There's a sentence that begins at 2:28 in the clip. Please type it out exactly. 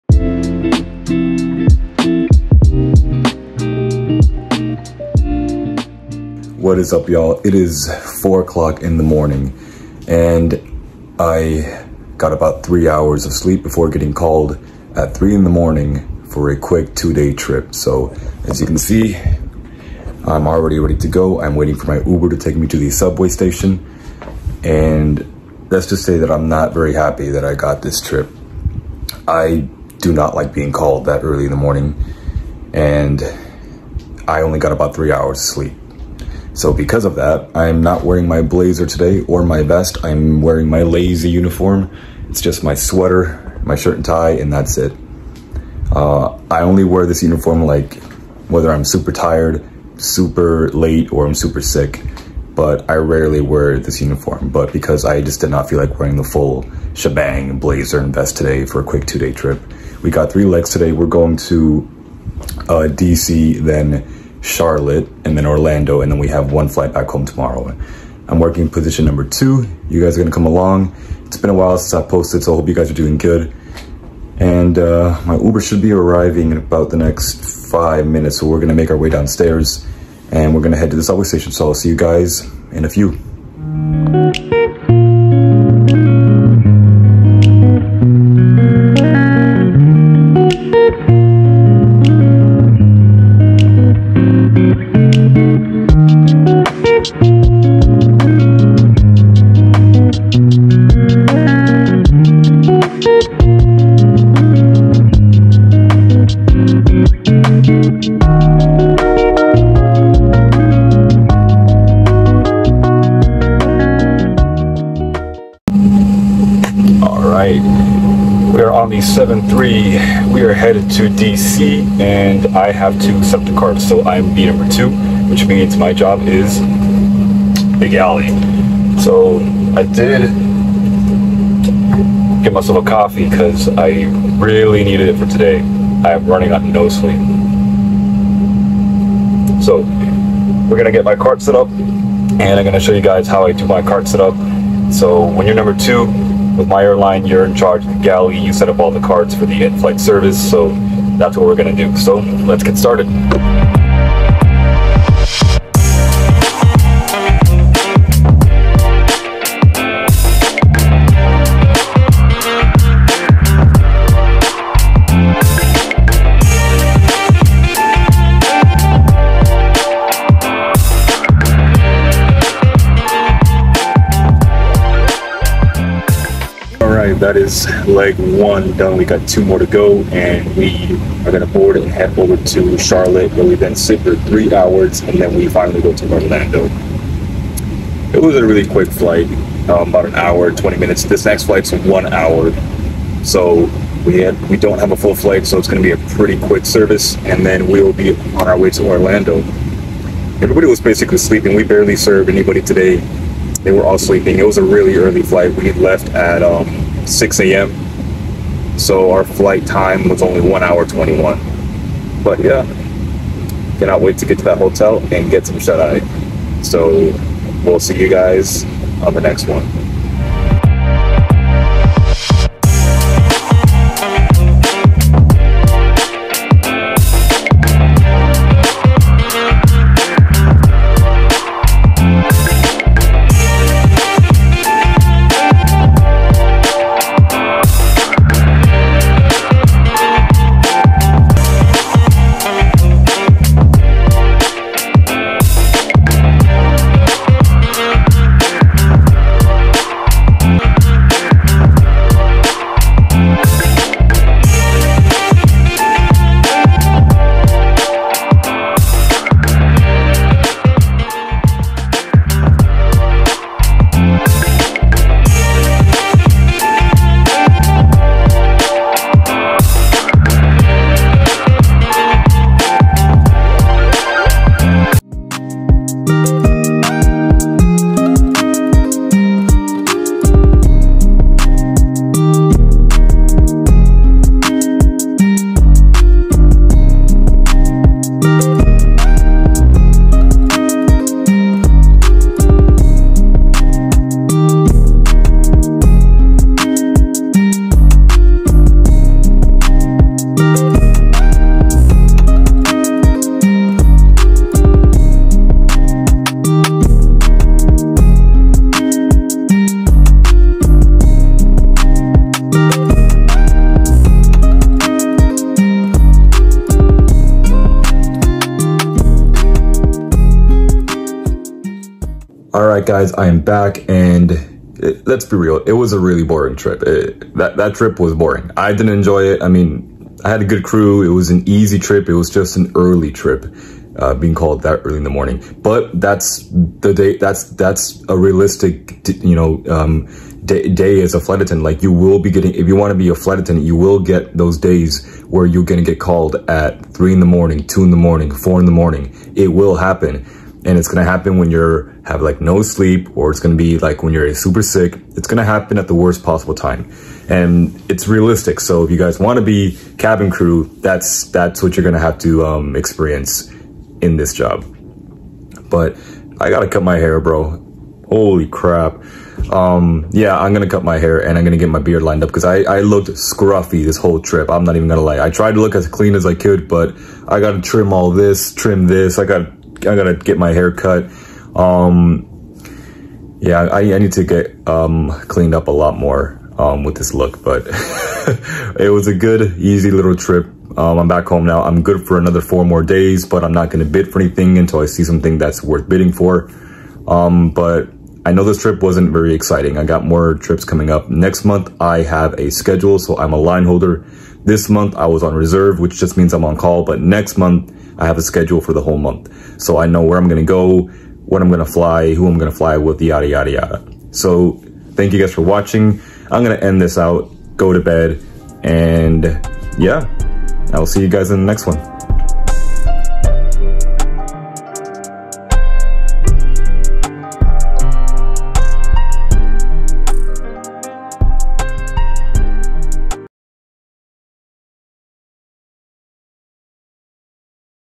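You set up all the cards for the in-flight service.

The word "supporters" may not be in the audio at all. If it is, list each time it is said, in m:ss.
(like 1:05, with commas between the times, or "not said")
not said.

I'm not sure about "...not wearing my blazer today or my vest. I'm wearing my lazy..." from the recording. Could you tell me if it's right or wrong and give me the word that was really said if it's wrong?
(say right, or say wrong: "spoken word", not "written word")
right.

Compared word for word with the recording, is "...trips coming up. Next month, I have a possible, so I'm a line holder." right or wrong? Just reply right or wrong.
wrong.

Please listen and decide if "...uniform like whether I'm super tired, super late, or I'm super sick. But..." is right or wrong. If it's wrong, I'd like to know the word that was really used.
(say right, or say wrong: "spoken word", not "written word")
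right.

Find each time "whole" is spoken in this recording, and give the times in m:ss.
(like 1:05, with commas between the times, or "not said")
6:13, 6:48.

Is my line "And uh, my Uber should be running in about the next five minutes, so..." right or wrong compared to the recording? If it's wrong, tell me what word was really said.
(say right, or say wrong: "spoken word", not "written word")
wrong: "arriving", not "running".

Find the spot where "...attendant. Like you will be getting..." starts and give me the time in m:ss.
5:41.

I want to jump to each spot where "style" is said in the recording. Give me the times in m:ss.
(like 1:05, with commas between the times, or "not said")
not said.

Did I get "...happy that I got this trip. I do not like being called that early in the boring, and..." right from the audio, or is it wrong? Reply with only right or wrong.
wrong.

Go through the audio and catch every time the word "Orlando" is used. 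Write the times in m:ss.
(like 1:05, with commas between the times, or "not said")
1:05, 3:06, 3:18.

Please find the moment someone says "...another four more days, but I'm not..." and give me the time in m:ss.
6:32.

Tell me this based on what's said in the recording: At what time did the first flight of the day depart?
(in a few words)
6 a.m.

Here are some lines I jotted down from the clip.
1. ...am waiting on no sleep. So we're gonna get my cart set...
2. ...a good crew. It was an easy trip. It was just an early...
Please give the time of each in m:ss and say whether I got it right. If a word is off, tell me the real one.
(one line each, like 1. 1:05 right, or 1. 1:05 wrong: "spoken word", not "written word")
1. 2:16 wrong: "running", not "waiting"
2. 5:30 right.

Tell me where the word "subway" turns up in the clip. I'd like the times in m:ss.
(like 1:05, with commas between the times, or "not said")
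0:22, 1:21.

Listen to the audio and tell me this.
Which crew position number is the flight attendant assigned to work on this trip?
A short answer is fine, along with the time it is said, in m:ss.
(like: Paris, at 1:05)
2, at 1:08.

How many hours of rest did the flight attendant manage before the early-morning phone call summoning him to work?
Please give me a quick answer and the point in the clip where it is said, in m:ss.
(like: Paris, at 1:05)
3, at 0:12.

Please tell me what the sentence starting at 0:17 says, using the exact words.
So, as you can see, I'm already ready to go.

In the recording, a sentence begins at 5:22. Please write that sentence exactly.
all right, guys, I am back.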